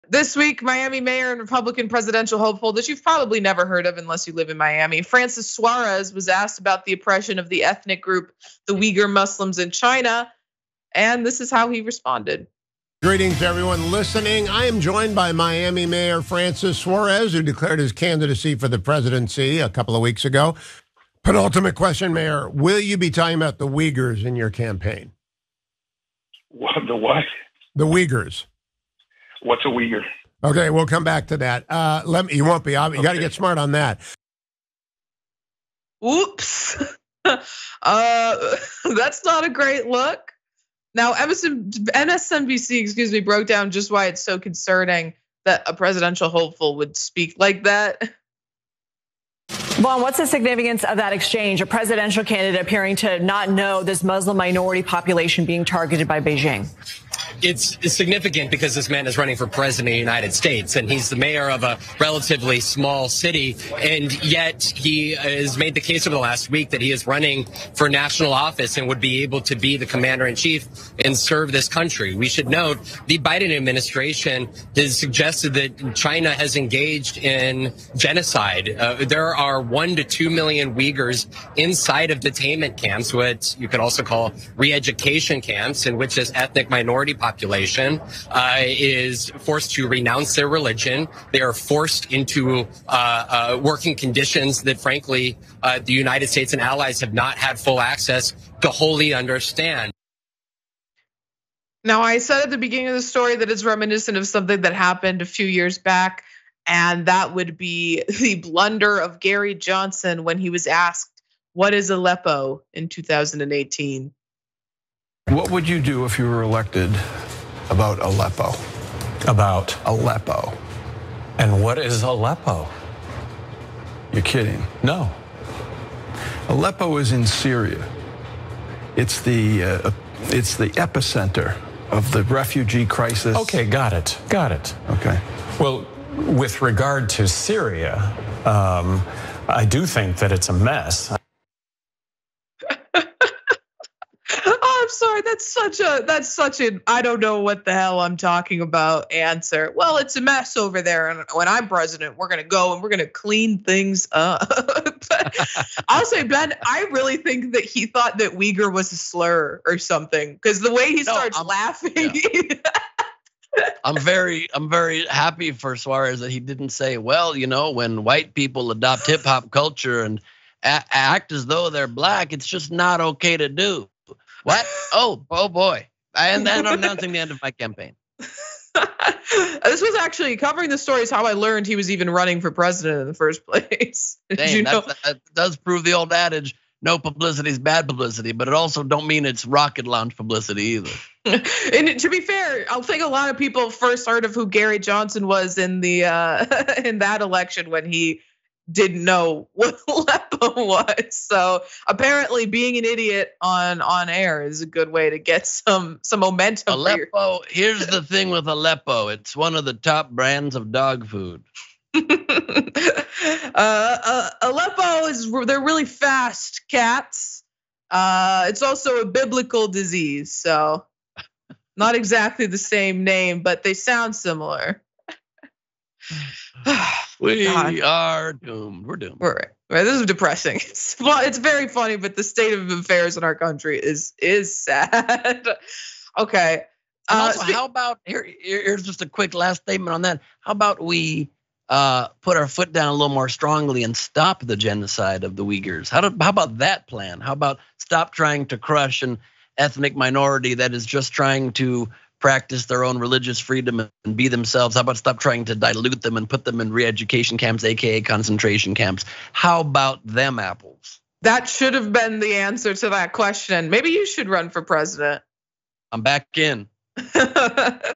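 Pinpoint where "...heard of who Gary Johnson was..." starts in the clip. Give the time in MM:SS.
03:14.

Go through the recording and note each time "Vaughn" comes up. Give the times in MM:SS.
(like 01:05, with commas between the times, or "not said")
00:49.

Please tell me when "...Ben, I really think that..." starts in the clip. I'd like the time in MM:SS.
02:36.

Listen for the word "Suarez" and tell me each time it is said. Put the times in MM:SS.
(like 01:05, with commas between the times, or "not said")
00:05, 00:16, 02:45.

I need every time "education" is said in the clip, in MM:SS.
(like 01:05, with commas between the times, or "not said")
01:24, 04:16.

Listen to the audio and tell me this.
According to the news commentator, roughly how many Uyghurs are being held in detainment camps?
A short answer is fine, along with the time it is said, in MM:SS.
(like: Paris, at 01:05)
1 to 2 million, at 01:19.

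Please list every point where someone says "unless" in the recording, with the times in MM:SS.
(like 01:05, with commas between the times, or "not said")
00:03.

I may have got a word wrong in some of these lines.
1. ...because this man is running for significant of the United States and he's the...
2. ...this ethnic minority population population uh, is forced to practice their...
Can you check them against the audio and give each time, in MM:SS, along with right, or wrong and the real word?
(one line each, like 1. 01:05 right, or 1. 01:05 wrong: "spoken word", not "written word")
1. 00:58 wrong: "president", not "significant"
2. 01:26 wrong: "renounce", not "practice".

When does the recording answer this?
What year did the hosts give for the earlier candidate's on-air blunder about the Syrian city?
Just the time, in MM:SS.
01:52.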